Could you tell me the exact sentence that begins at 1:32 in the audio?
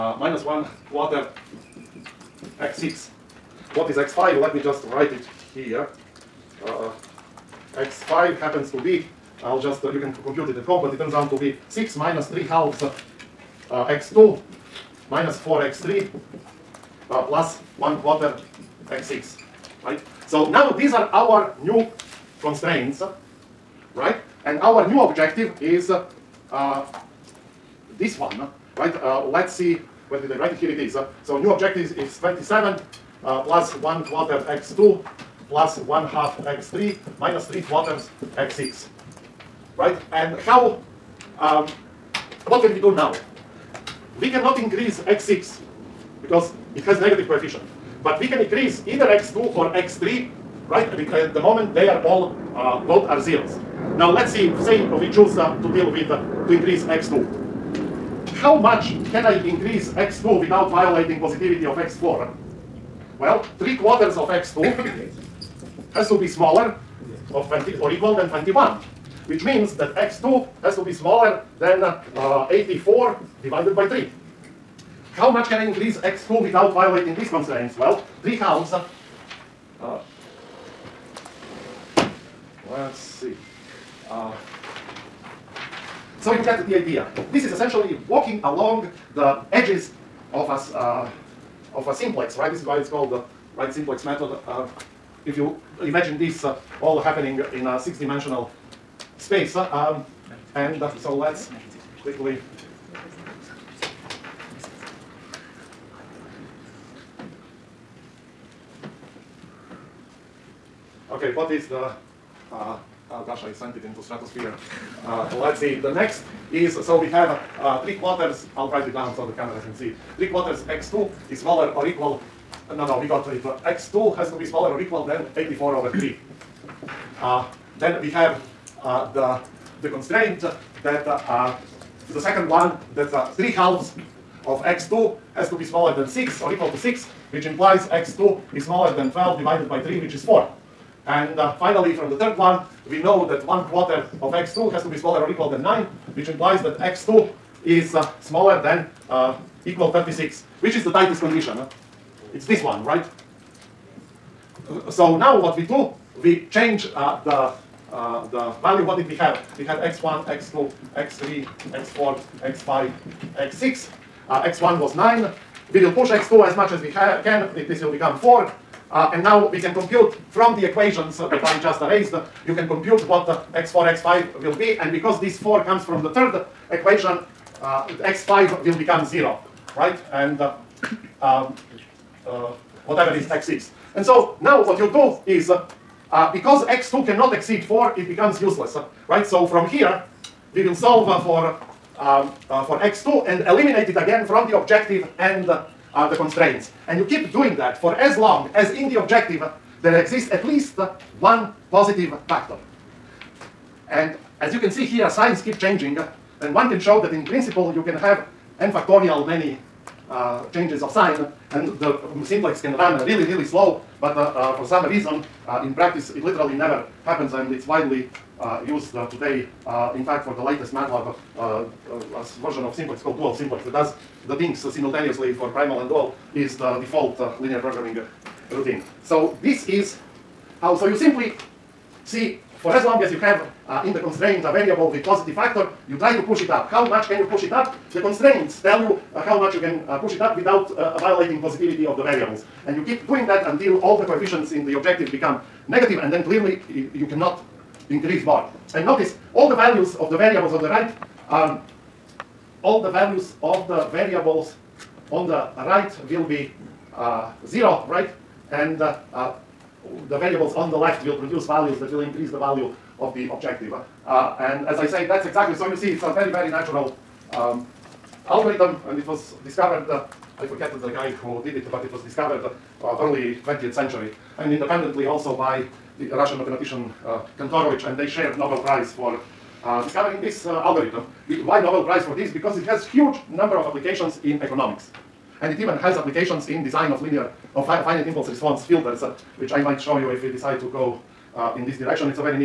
This is why it's called the right simplex method.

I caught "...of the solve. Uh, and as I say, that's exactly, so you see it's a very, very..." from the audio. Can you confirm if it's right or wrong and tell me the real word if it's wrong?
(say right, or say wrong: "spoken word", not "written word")
wrong: "objective", not "solve".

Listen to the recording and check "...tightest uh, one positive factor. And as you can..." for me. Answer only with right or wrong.
wrong.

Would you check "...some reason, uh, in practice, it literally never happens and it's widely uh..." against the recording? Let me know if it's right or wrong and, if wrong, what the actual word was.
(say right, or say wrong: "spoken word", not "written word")
right.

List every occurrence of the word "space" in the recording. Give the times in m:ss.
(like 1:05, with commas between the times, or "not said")
1:39.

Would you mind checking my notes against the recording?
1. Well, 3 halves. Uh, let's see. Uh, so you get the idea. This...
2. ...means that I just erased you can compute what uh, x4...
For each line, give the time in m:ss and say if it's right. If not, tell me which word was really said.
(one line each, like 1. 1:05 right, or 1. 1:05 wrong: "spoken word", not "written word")
1. 1:17 right
2. 2:50 wrong: "equations", not "means".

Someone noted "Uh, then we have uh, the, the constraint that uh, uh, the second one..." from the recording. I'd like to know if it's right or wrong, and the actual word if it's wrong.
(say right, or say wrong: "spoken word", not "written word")
right.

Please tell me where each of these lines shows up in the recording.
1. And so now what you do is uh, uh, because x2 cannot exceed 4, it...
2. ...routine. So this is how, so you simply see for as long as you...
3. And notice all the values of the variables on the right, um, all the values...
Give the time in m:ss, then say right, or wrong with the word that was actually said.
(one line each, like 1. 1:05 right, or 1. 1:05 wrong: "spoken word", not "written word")
1. 3:03 right
2. 3:48 right
3. 4:08 right.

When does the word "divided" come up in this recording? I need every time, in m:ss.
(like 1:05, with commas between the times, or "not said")
1:13, 2:19.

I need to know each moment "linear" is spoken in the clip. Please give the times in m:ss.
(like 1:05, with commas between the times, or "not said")
3:47, 4:47.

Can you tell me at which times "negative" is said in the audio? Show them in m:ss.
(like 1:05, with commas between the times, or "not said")
0:47, 4:05.